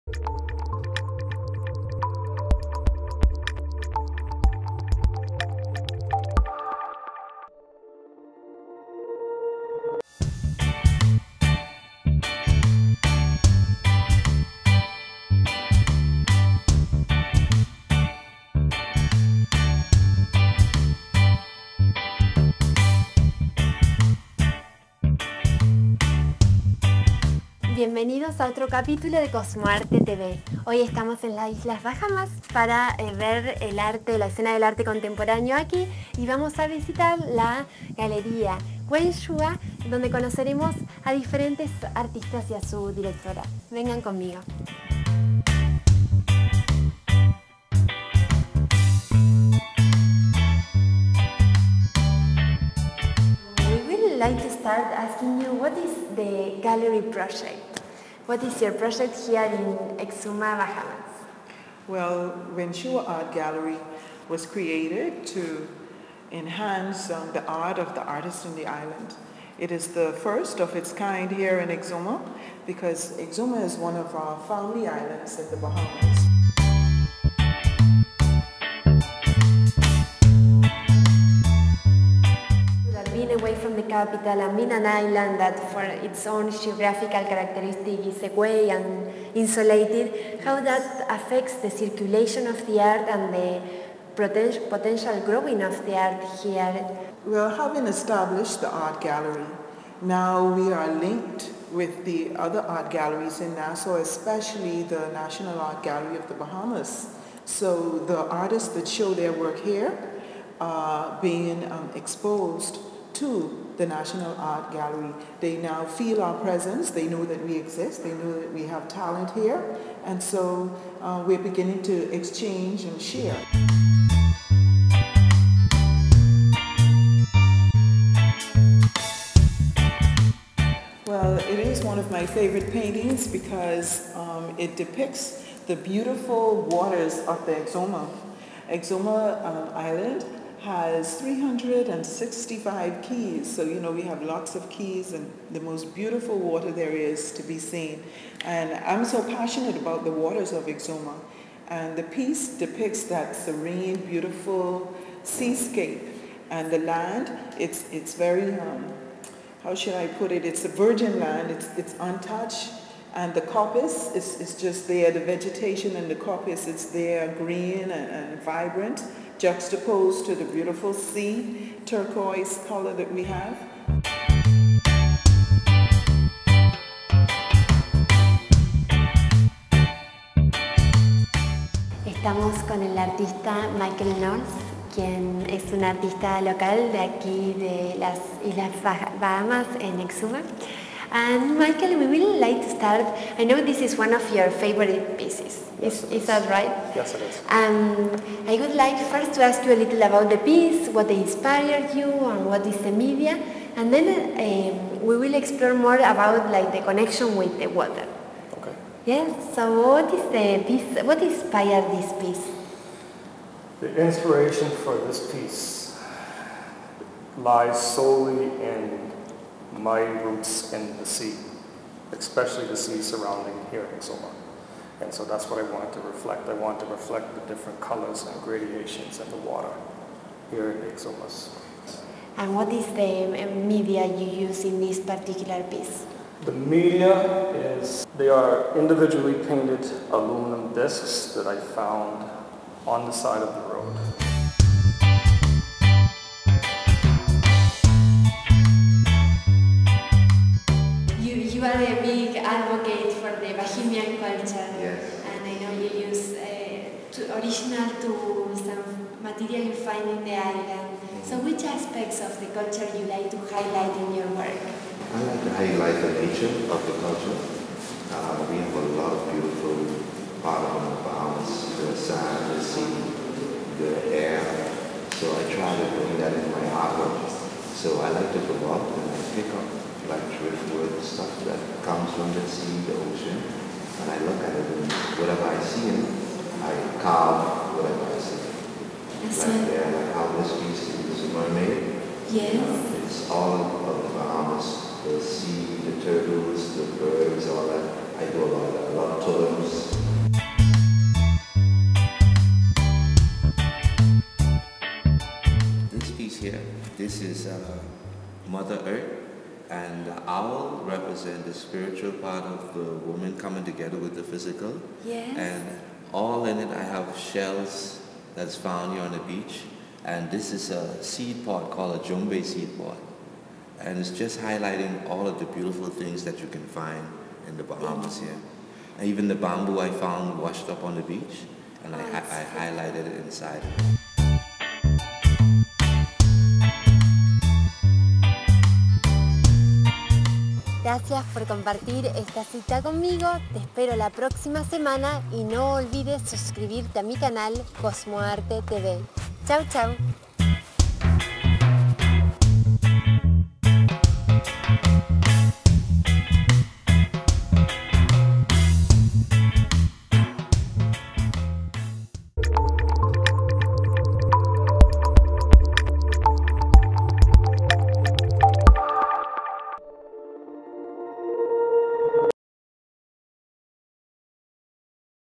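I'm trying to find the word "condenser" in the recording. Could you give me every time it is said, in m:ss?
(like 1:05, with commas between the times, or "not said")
not said.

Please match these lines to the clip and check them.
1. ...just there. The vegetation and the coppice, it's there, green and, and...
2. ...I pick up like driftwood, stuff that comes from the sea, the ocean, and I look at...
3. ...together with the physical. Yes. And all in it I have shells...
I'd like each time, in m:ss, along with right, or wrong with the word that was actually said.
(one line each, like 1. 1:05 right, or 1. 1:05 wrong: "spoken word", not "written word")
1. 2:44 right
2. 4:39 right
3. 5:13 right.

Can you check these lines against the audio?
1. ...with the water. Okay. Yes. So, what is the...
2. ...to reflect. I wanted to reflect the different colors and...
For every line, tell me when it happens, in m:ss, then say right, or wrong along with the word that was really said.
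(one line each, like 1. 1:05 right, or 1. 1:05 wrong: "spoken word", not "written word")
1. 3:27 right
2. 3:45 right.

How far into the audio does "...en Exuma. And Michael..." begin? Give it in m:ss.
3:09.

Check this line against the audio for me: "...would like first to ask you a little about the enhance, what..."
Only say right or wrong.
wrong.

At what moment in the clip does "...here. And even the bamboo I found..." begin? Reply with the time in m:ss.
5:28.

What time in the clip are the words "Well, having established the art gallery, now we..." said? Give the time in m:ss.
1:37.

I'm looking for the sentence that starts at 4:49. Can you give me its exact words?
there, like how this piece is a made.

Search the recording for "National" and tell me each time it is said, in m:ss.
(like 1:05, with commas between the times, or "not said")
1:45, 1:53.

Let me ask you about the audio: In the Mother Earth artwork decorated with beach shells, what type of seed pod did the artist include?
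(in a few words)
Jumbay seed pod.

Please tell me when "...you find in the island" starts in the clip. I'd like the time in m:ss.
4:19.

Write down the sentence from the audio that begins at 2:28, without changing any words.
And I'm so passionate about the waters of Exuma.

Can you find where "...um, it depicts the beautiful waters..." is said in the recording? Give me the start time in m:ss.
2:14.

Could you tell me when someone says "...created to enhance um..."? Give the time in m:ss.
1:04.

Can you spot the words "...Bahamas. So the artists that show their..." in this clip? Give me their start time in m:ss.
1:46.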